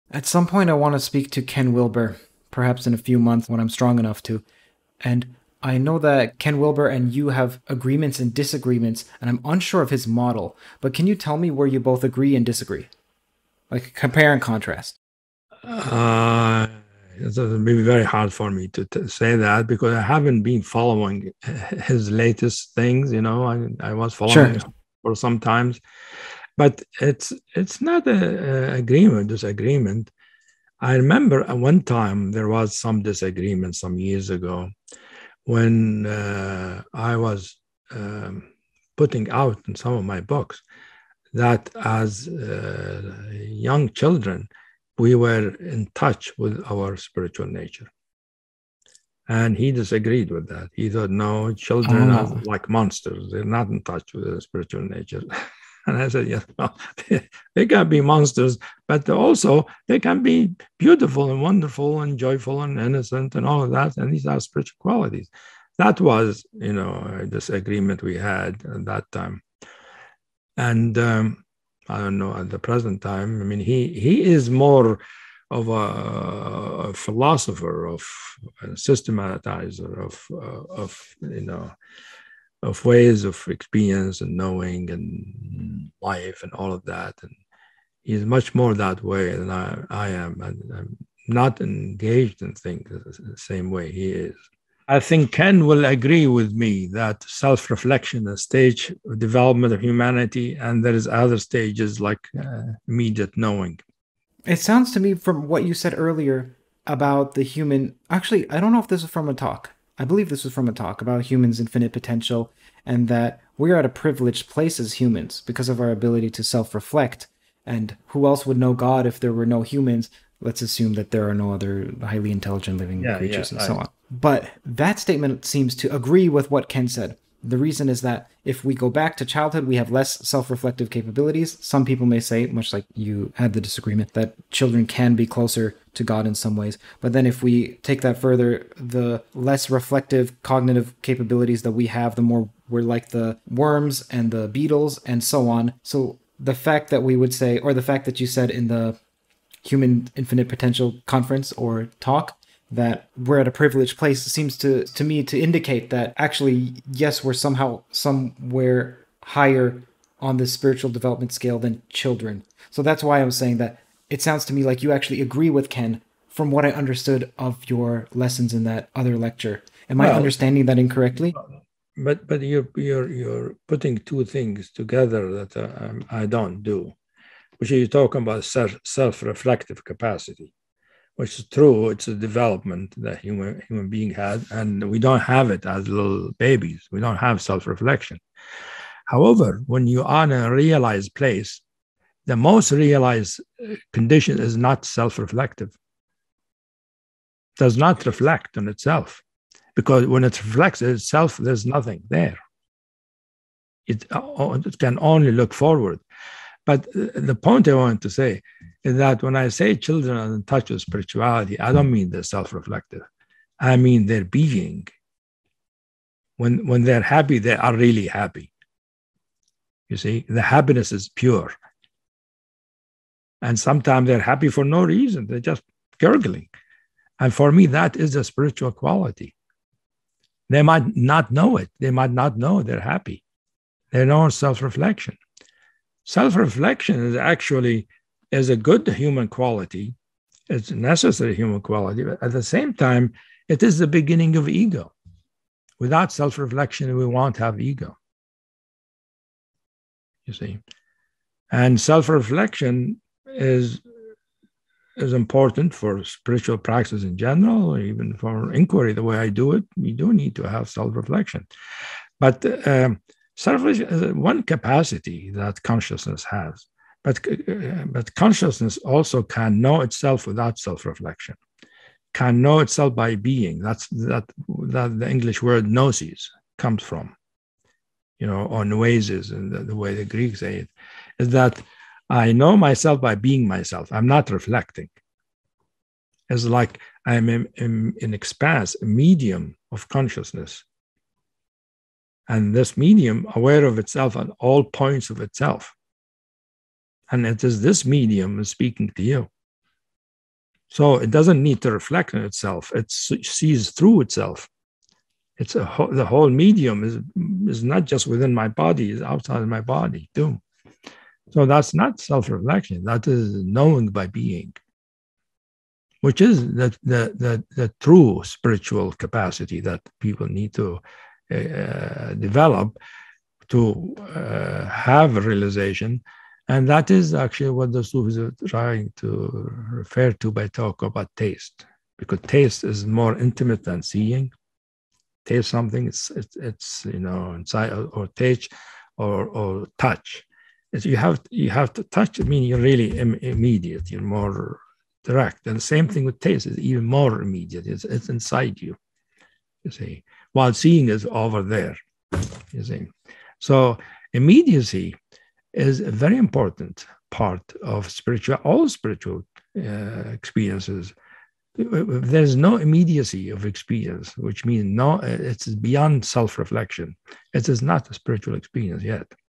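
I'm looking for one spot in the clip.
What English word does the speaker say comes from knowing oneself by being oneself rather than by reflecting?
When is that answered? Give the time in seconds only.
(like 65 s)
275 s.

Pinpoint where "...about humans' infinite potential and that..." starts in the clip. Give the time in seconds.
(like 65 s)
111 s.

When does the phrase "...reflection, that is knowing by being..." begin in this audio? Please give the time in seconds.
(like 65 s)
312 s.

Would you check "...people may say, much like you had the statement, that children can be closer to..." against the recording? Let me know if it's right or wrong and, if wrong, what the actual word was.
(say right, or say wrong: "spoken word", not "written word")
wrong: "disagreement", not "statement".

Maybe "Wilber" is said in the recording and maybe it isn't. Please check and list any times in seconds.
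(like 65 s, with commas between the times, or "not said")
1 s, 6 s.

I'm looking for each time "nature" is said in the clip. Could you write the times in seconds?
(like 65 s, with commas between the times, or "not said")
47 s, 54 s.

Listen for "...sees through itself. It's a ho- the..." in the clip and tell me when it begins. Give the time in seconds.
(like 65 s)
302 s.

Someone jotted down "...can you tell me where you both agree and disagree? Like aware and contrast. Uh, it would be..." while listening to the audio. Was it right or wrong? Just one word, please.
wrong.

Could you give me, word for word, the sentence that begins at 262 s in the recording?
But um, self-reflection is one capacity that consciousness has.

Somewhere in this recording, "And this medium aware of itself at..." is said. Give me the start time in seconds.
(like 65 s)
292 s.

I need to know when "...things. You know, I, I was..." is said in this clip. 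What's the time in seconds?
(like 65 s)
22 s.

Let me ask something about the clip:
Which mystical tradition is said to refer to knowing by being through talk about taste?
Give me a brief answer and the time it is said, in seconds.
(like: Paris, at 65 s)
the Sufis, at 327 s.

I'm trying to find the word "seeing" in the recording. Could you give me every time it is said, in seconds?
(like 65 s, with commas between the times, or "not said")
333 s, 350 s.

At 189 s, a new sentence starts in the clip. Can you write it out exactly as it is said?
However, when you are in a realized place, the most realized uh, condition is not self reflective, does not reflect on itself.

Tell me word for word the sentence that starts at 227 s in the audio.
And for me, that is a spiritual quality.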